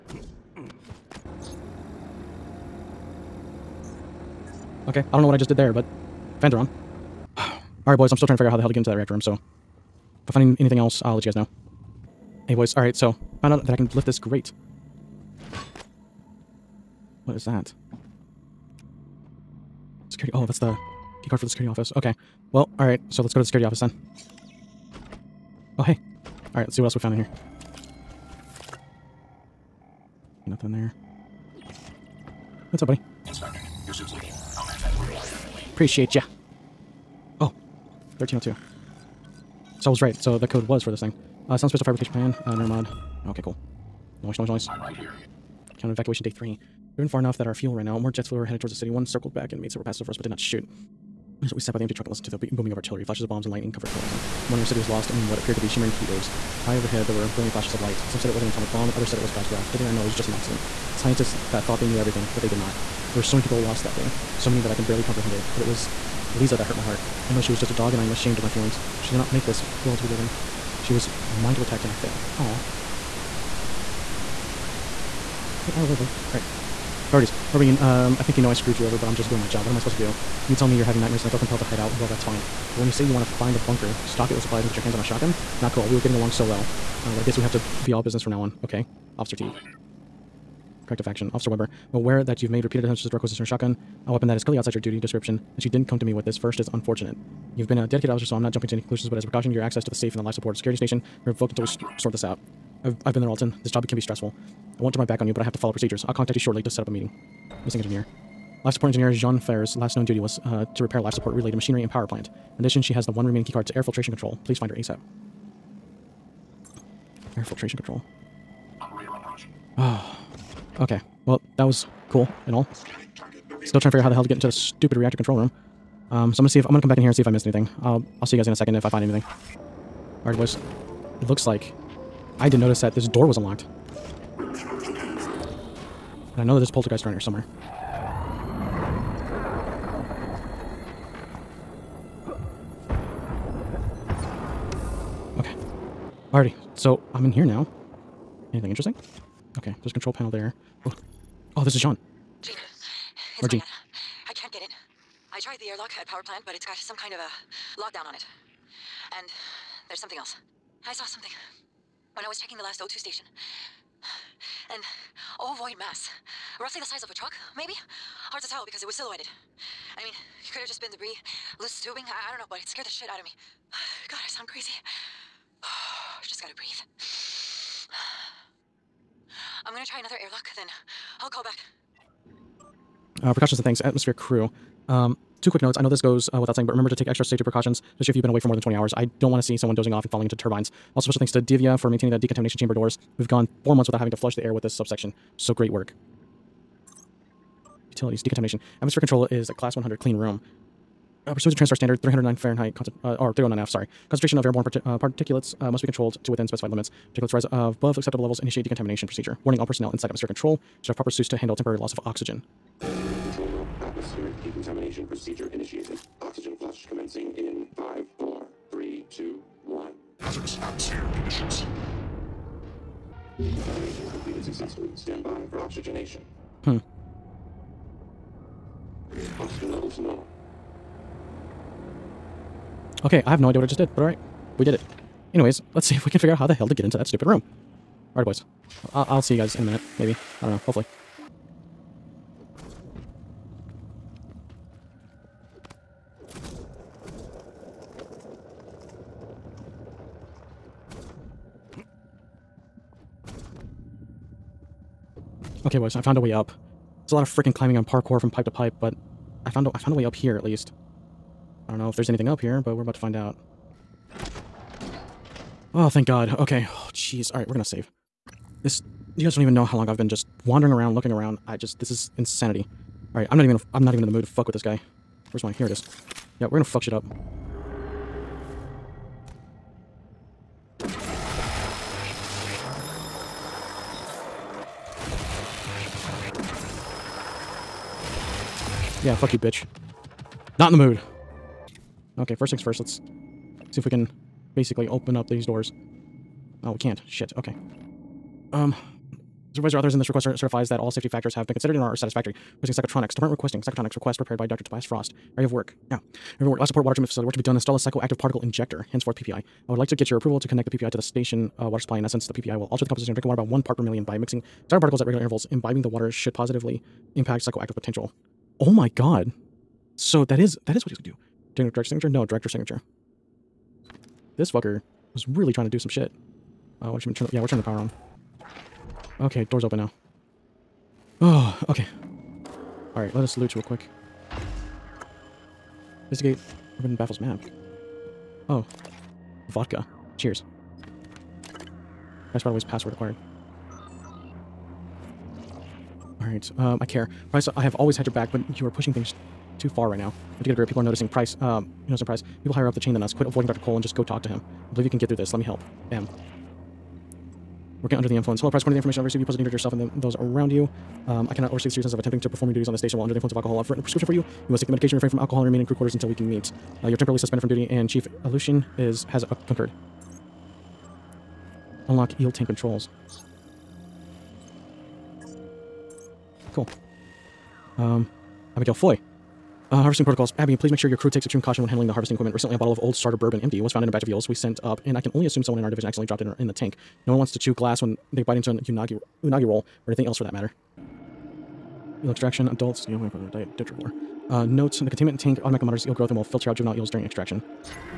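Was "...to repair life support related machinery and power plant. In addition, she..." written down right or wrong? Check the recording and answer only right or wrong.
right.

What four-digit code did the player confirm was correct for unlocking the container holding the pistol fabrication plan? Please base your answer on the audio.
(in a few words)
1302.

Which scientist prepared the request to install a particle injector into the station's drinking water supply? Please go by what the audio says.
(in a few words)
Dr. Tobias Frost.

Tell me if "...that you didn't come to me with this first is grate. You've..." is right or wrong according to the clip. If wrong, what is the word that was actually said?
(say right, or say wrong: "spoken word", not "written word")
wrong: "unfortunate", not "grate".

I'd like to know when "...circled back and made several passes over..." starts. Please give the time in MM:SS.
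00:49.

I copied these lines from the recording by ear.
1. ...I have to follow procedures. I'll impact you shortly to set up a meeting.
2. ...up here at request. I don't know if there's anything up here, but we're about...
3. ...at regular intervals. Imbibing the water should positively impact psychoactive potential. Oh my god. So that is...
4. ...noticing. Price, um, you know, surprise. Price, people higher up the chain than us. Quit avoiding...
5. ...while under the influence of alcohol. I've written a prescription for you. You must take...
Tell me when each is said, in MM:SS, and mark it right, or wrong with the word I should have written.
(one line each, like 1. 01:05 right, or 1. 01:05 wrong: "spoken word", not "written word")
1. 01:45 wrong: "contact", not "impact"
2. 04:20 wrong: "least", not "request"
3. 05:15 right
4. 05:50 right
5. 06:02 right.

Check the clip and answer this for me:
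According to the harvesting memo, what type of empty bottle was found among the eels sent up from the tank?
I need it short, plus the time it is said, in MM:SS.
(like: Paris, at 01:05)
Bourbon, at 06:23.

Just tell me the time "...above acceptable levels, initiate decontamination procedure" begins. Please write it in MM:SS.
03:27.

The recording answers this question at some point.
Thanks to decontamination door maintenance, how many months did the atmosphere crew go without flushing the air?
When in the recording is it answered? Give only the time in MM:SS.
03:13.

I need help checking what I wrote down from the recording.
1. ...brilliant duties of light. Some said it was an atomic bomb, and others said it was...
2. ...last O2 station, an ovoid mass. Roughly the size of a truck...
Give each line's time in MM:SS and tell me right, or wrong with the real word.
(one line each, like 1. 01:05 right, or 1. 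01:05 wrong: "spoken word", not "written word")
1. 00:57 wrong: "flashes", not "duties"
2. 02:42 right.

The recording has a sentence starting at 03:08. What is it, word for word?
I don't want to see someone dozing off and falling into turbines.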